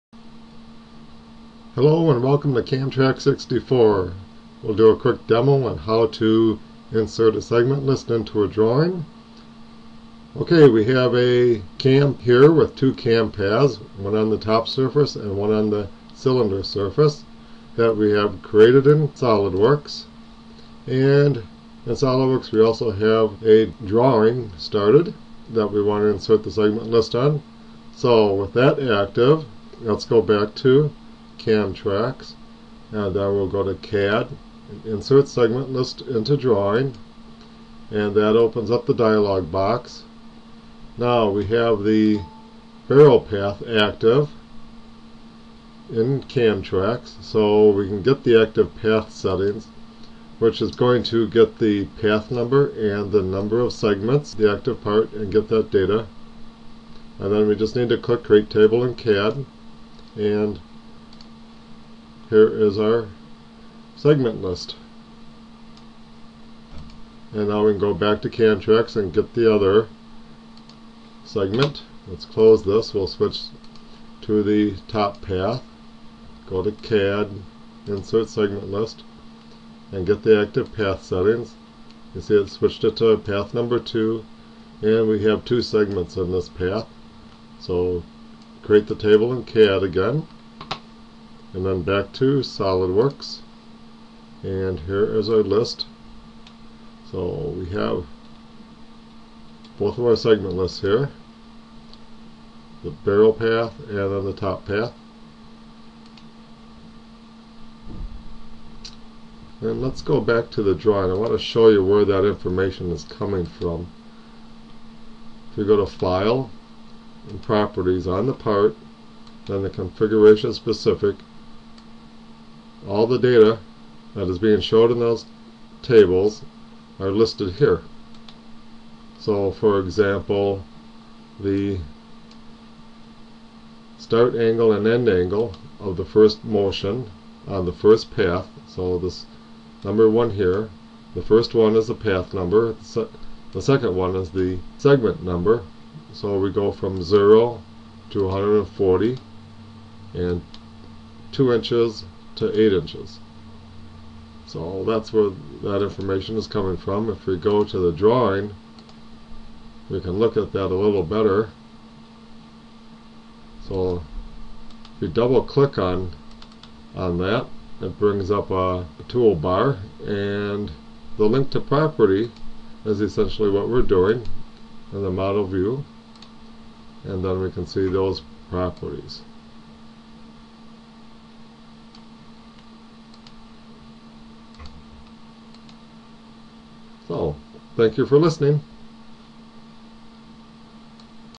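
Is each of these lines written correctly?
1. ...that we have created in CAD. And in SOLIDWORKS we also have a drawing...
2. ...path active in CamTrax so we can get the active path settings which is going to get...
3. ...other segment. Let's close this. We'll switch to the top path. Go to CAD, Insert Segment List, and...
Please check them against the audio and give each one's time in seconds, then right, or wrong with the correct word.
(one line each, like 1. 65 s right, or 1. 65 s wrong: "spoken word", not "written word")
1. 17 s wrong: "SOLIDWORKS", not "CAD"
2. 43 s right
3. 69 s right.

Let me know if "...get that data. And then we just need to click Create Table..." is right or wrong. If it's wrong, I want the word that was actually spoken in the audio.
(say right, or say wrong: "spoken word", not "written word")
right.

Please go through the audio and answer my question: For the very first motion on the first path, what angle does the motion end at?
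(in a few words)
140.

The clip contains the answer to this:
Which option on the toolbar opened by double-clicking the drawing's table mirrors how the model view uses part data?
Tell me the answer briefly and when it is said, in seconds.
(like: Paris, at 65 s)
link to property, at 171 s.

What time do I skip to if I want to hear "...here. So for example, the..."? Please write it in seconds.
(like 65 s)
127 s.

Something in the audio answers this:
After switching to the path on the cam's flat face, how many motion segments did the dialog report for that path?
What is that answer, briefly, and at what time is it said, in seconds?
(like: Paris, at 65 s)
2, at 85 s.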